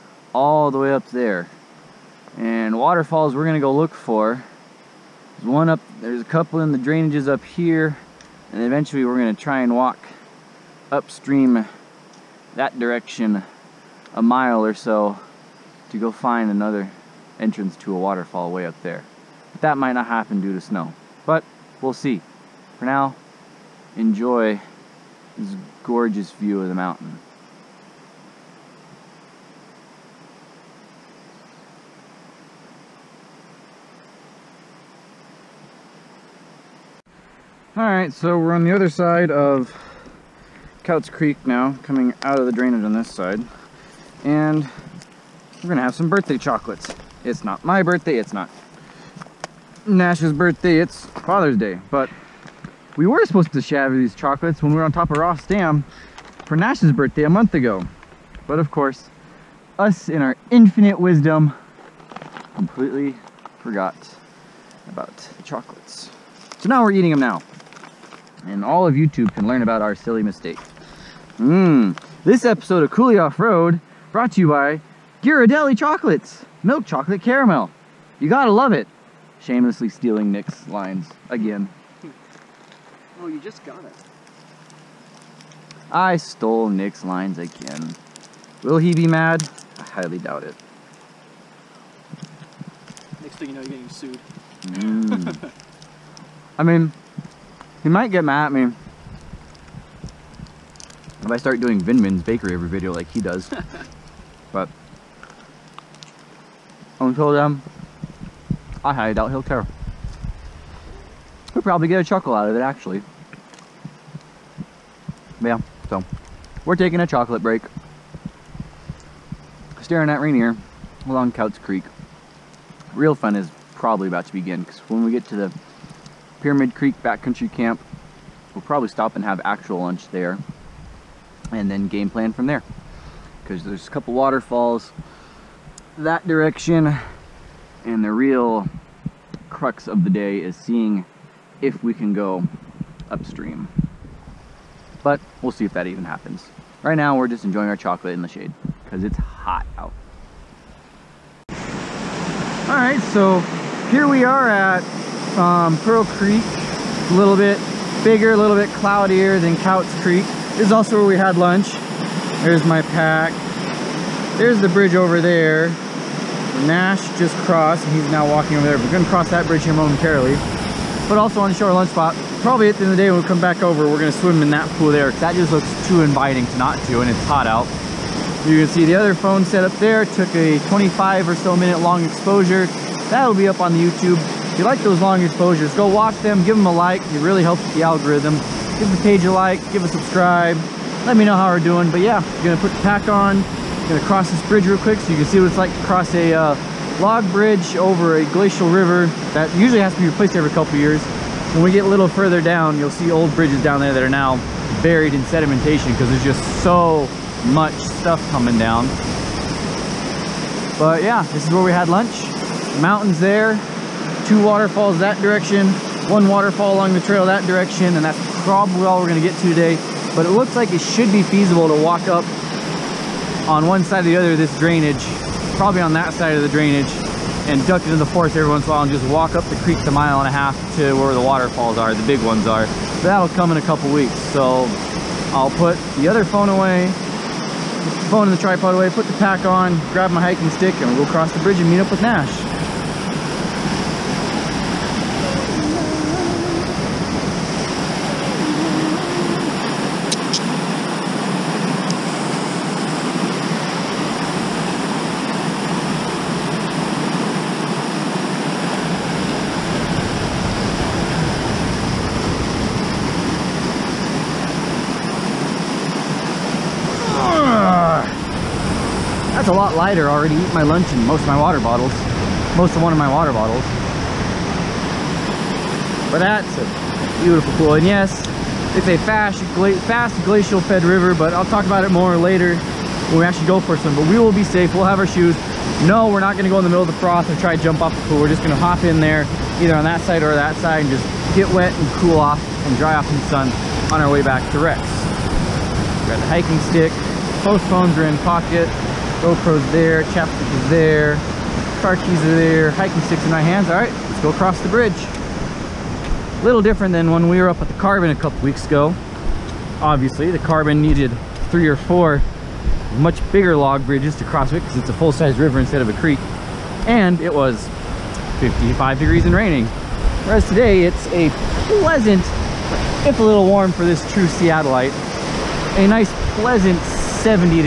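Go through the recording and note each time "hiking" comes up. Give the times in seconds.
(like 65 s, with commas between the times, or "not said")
240 s, 296 s, 302 s.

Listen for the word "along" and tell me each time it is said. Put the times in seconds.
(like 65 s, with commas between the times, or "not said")
121 s, 216 s.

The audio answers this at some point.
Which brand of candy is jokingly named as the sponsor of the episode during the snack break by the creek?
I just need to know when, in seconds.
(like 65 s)
75 s.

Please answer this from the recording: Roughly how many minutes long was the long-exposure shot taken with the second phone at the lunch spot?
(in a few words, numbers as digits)
25.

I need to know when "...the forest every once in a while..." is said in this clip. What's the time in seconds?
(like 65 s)
227 s.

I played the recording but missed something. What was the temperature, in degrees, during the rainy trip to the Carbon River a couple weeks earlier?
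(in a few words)
55.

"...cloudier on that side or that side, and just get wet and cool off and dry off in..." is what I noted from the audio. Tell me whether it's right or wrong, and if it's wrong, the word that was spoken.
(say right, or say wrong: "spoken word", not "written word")
wrong: "either", not "cloudier".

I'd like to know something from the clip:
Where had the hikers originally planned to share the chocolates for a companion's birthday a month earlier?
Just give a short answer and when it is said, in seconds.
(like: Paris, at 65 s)
Ross Dam, at 55 s.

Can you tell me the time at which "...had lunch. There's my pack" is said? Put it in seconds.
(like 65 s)
161 s.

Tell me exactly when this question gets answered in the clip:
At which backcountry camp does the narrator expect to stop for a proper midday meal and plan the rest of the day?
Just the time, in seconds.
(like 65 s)
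126 s.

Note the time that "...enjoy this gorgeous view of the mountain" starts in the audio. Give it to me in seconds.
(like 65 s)
23 s.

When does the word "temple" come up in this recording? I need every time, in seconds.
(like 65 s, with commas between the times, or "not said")
not said.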